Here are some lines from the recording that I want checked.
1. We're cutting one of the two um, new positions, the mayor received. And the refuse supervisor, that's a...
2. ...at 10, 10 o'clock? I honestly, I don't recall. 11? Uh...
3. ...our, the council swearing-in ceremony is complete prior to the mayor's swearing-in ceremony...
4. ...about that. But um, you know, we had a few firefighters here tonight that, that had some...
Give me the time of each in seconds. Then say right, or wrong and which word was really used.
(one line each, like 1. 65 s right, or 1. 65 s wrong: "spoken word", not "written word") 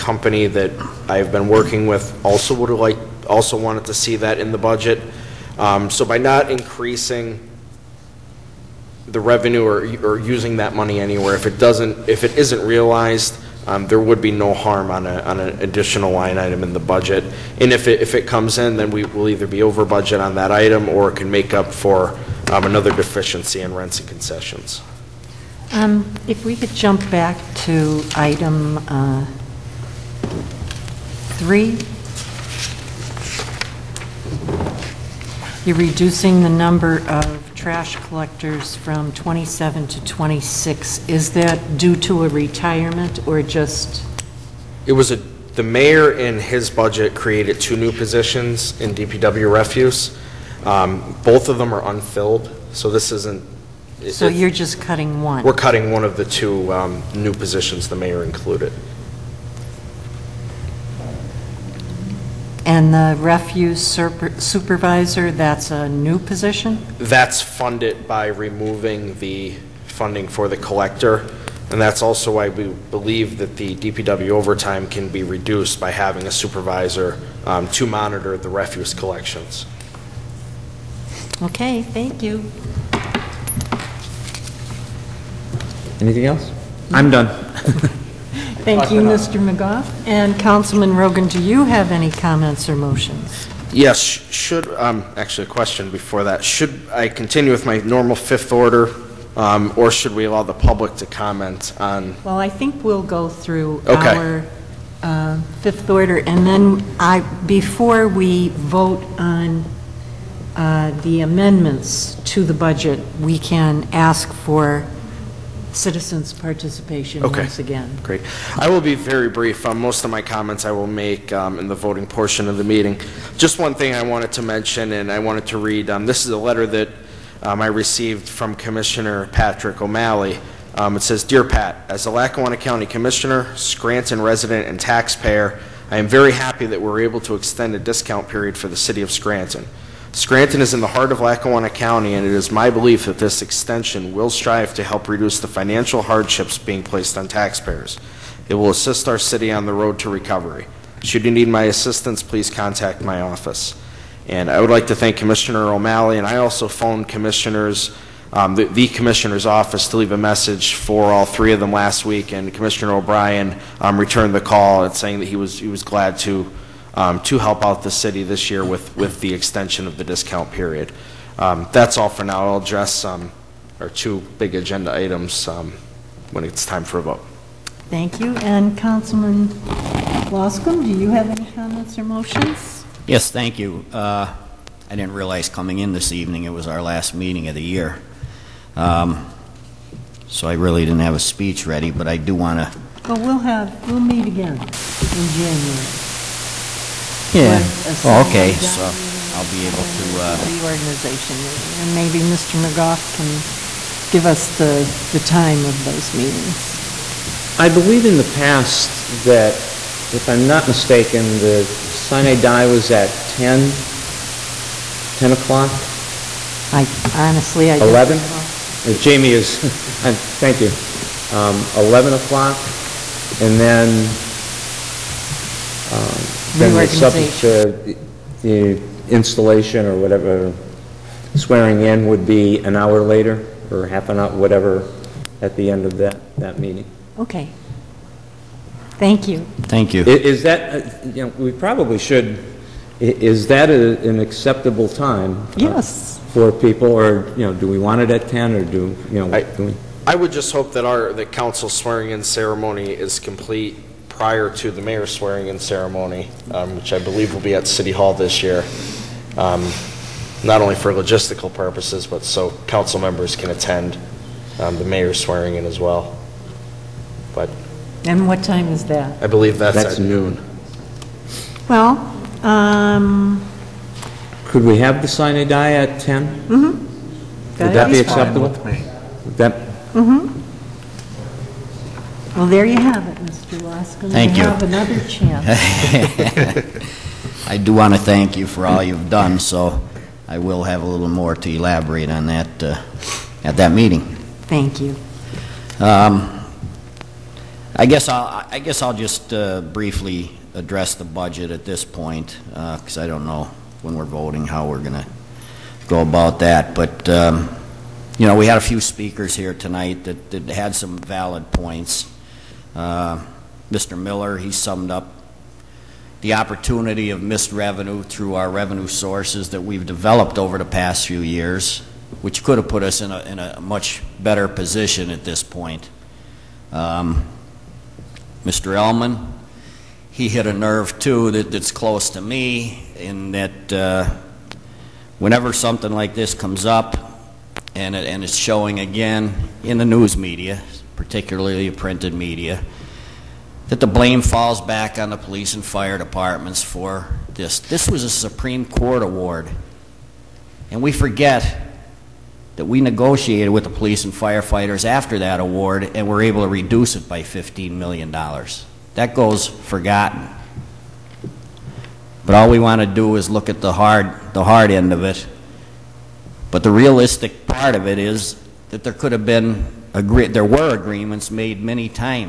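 1. 55 s wrong: "included", not "received"
2. 212 s right
3. 250 s right
4. 306 s wrong: "speakers", not "firefighters".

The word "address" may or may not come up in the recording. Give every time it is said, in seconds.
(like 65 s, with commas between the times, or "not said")
172 s, 300 s.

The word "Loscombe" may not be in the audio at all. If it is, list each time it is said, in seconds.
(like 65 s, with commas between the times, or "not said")
180 s, 283 s.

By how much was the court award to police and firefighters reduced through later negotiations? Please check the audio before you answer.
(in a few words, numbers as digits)
$15 million.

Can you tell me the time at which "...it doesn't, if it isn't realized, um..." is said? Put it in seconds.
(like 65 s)
11 s.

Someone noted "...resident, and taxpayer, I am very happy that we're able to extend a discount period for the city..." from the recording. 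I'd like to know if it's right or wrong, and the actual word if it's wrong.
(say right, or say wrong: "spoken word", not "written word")
right.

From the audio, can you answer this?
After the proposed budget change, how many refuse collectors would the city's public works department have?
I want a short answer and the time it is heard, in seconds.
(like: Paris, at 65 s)
26, at 40 s.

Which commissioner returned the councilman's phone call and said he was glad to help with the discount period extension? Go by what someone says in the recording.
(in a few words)
Commissioner O'Brien.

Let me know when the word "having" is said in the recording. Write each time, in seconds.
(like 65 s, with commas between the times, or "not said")
75 s.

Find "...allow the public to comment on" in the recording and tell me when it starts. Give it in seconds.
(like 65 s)
100 s.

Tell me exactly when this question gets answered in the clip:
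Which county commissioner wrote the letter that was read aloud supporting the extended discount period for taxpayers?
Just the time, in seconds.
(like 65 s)
129 s.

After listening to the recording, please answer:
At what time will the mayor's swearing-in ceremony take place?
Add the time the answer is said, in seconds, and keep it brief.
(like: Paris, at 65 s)
Noon, at 269 s.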